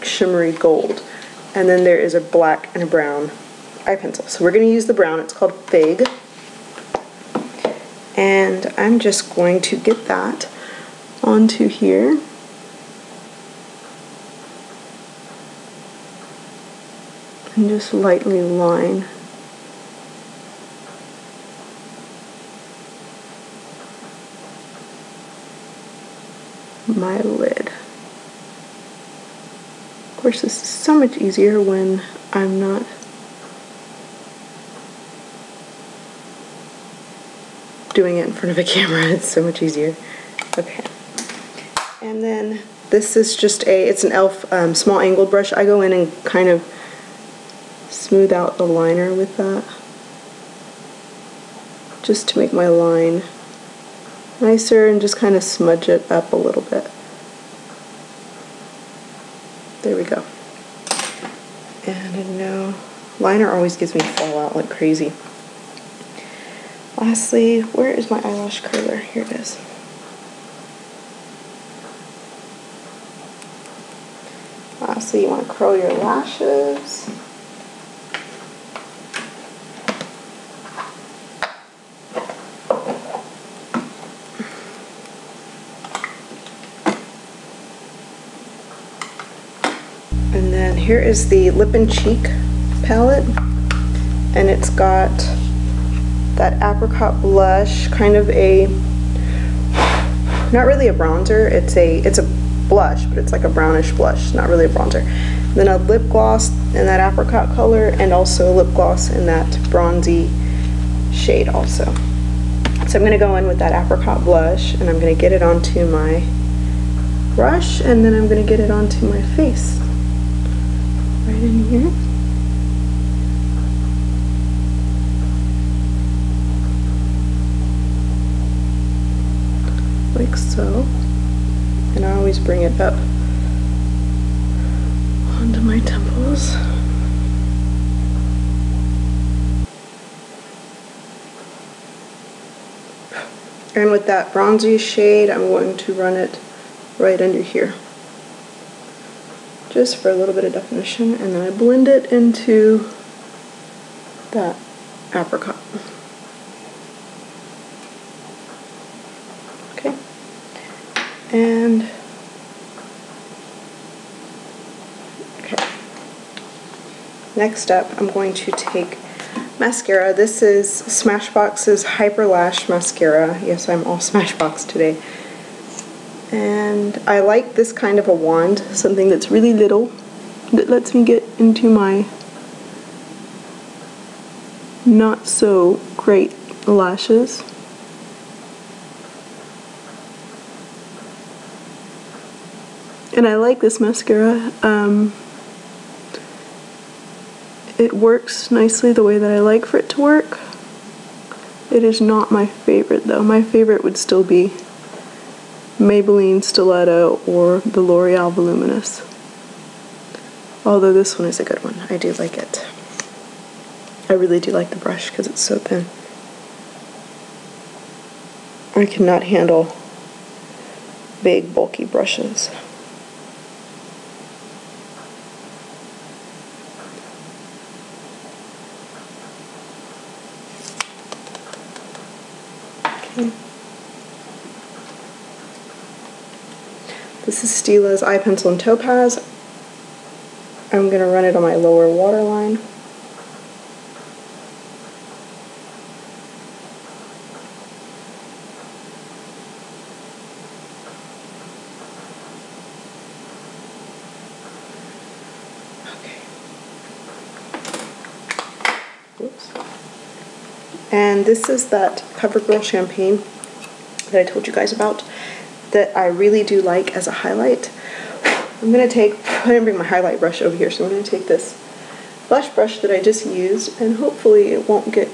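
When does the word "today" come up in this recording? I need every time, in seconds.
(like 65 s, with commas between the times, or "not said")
174 s.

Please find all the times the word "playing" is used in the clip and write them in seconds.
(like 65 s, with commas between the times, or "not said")
not said.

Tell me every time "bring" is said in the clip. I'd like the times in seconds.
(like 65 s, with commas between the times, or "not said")
132 s, 269 s.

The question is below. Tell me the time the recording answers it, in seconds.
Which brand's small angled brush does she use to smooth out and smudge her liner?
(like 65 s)
44 s.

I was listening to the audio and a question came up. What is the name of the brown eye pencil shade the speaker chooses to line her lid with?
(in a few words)
Fig.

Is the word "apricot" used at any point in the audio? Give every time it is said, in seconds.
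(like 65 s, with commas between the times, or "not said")
96 s, 107 s, 113 s, 155 s.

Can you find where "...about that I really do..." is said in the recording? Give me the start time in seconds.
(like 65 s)
264 s.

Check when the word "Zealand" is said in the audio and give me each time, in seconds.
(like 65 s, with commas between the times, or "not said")
not said.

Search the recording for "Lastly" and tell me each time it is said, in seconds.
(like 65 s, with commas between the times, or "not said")
66 s, 74 s.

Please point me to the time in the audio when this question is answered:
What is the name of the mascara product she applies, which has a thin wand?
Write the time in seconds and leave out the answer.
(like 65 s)
171 s.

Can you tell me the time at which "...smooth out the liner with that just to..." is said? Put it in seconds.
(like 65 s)
47 s.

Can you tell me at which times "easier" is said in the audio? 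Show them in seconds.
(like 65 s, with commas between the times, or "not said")
31 s, 39 s.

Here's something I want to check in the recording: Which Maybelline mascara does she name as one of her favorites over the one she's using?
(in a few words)
Stiletto.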